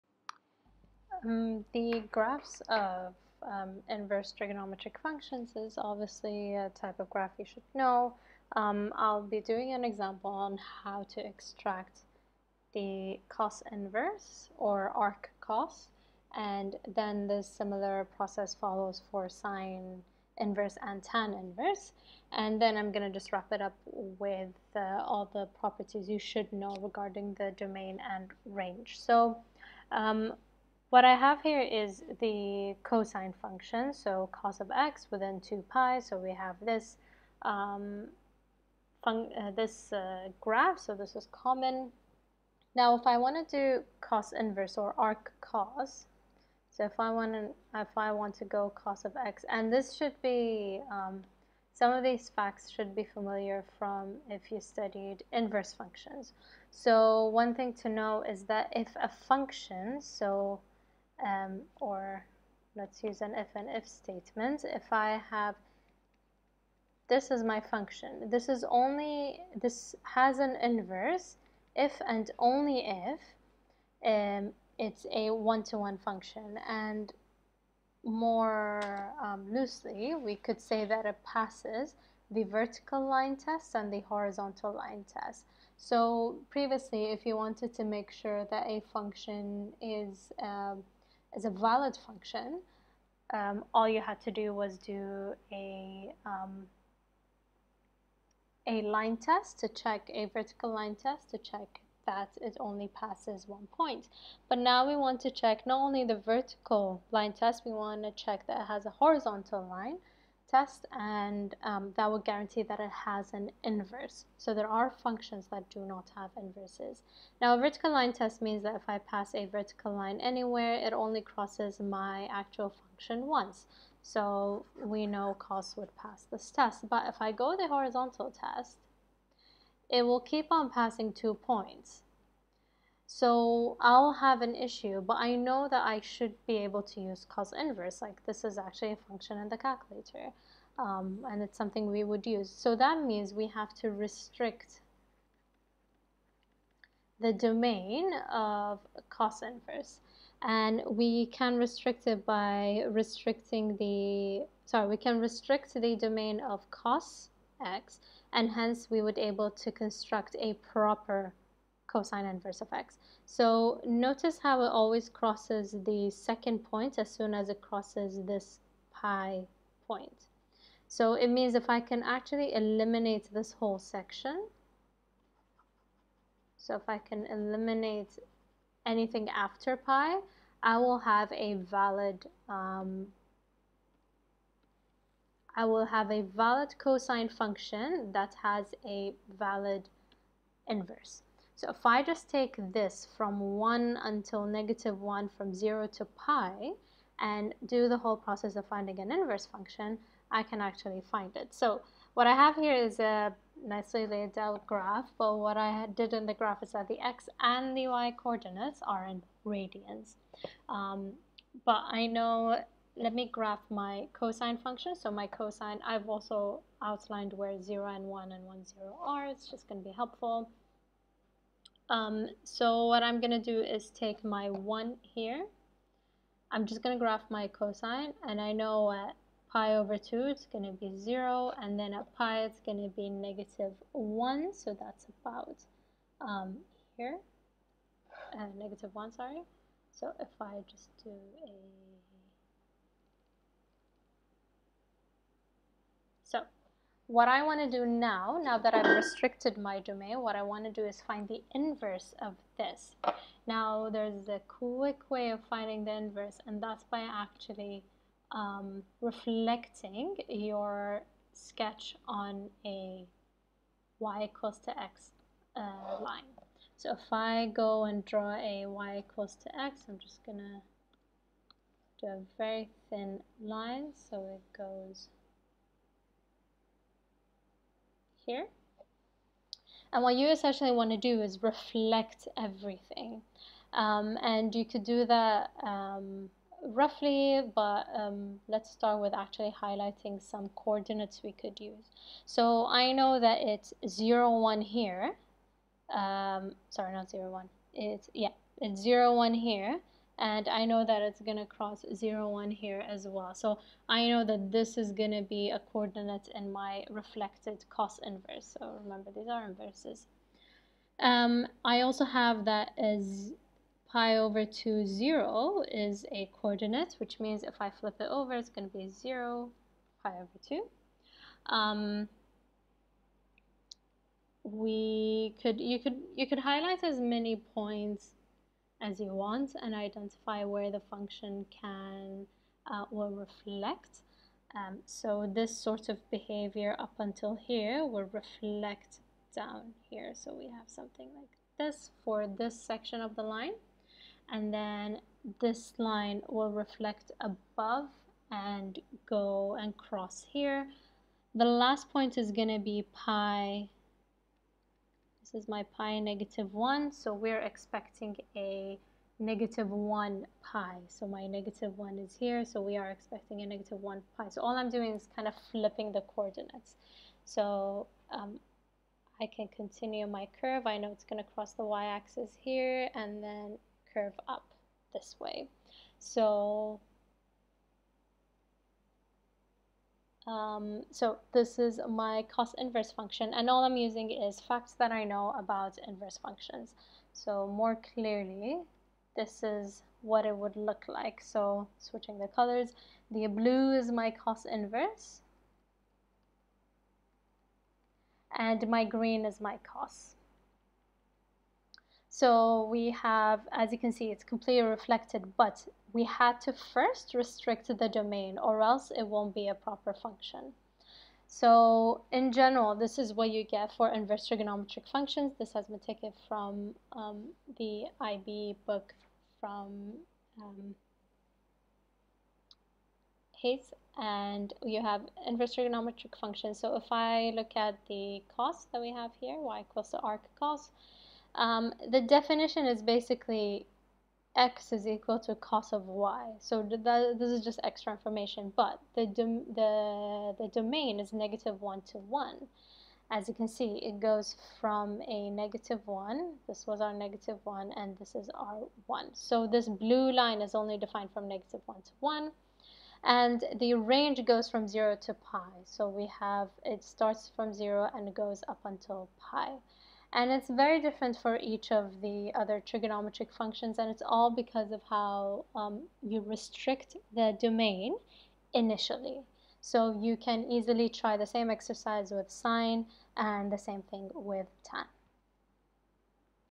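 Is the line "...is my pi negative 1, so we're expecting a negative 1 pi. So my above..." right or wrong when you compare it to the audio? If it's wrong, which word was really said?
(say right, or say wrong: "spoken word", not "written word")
wrong: "negative", not "above".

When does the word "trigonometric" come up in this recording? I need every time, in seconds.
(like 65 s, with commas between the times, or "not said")
4 s, 414 s, 425 s, 462 s.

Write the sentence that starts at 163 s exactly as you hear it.
So notice how it always crosses the second point as soon as it crosses this pi point.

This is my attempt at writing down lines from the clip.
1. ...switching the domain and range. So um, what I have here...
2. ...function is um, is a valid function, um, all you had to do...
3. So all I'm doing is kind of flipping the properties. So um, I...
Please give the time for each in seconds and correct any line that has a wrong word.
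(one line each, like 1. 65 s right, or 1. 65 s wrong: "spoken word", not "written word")
1. 26 s wrong: "regarding", not "switching"
2. 88 s right
3. 364 s wrong: "coordinates", not "properties".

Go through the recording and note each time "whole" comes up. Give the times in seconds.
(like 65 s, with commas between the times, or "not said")
173 s, 197 s.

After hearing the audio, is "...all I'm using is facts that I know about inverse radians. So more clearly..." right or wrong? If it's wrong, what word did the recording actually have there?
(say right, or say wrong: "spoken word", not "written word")
wrong: "functions", not "radians".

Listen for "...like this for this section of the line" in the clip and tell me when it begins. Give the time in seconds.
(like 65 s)
341 s.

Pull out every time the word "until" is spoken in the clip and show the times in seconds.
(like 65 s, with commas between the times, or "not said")
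194 s, 336 s, 458 s.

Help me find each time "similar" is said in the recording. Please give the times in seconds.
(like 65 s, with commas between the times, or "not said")
17 s.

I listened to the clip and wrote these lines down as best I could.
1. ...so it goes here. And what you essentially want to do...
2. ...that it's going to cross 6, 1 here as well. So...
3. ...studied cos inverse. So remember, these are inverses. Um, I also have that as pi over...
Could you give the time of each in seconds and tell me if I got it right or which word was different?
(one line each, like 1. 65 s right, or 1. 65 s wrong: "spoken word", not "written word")
1. 273 s right
2. 300 s wrong: "0", not "6"
3. 306 s wrong: "reflected", not "studied".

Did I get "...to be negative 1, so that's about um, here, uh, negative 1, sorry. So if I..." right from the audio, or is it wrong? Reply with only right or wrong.
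right.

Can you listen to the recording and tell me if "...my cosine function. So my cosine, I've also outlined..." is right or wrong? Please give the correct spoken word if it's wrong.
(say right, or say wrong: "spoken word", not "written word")
right.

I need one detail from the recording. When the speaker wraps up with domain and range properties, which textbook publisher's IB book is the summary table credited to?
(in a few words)
Haese.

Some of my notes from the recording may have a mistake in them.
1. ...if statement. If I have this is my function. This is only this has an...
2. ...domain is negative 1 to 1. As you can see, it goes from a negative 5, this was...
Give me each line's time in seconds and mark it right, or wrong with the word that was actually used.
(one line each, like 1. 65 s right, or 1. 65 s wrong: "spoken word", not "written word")
1. 63 s right
2. 440 s wrong: "1", not "5".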